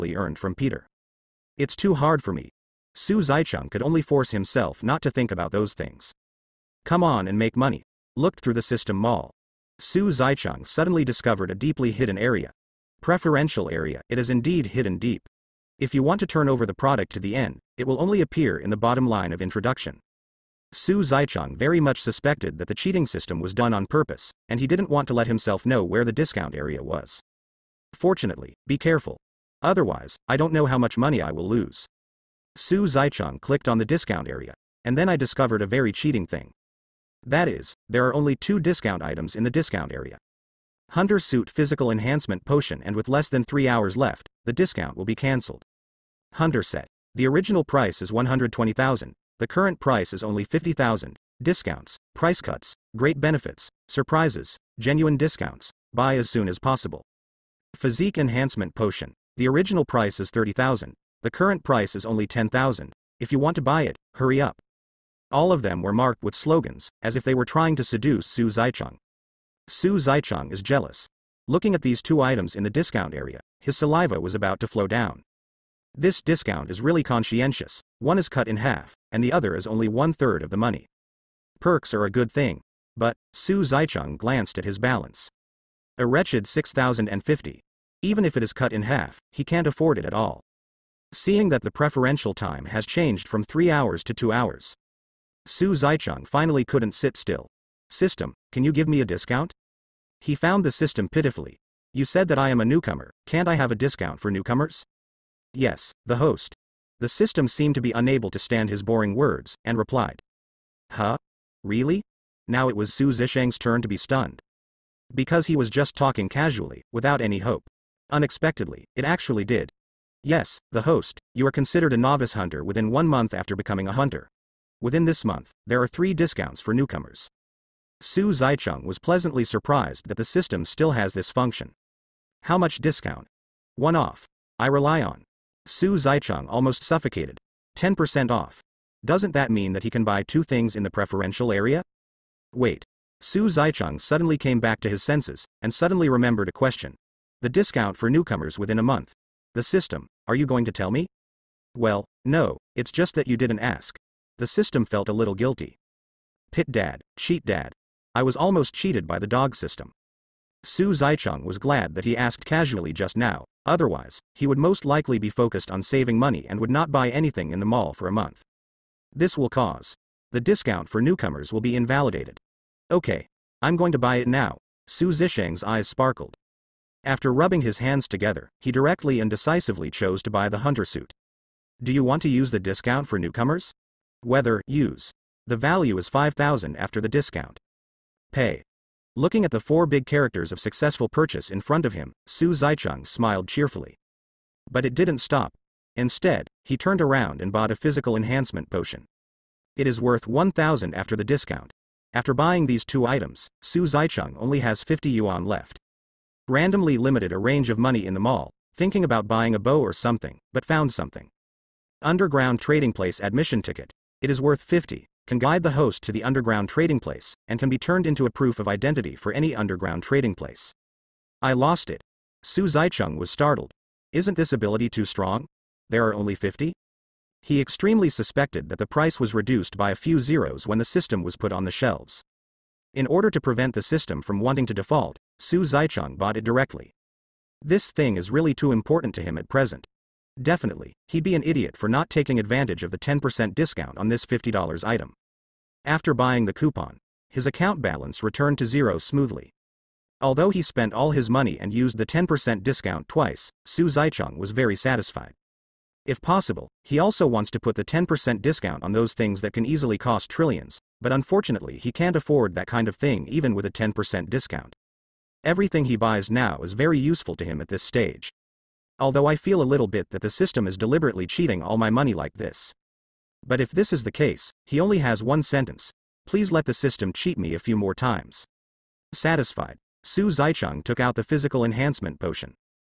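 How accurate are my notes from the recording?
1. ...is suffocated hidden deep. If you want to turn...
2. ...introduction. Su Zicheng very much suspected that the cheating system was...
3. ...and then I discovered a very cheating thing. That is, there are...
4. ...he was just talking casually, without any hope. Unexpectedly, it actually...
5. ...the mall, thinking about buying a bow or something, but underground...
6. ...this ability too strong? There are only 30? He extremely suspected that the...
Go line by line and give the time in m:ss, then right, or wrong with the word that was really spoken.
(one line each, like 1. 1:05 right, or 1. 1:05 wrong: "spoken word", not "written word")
1. 0:14 wrong: "indeed", not "suffocated"
2. 0:19 right
3. 0:34 right
4. 1:55 right
5. 3:28 wrong: "found", not "underground"
6. 3:44 wrong: "50", not "30".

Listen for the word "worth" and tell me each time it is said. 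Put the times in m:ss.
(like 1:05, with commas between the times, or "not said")
3:20, 3:34.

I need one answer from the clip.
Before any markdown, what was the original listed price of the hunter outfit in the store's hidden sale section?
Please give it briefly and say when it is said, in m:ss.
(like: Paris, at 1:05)
120,000, at 0:48.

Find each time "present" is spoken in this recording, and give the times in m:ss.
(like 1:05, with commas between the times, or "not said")
3:59.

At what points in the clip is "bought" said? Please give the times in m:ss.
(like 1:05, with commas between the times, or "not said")
3:17, 3:56.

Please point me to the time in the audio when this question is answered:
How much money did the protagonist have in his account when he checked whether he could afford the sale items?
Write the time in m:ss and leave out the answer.
1:26.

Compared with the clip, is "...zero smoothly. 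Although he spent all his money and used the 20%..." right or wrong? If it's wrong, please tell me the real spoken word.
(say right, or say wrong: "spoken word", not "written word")
wrong: "10", not "20".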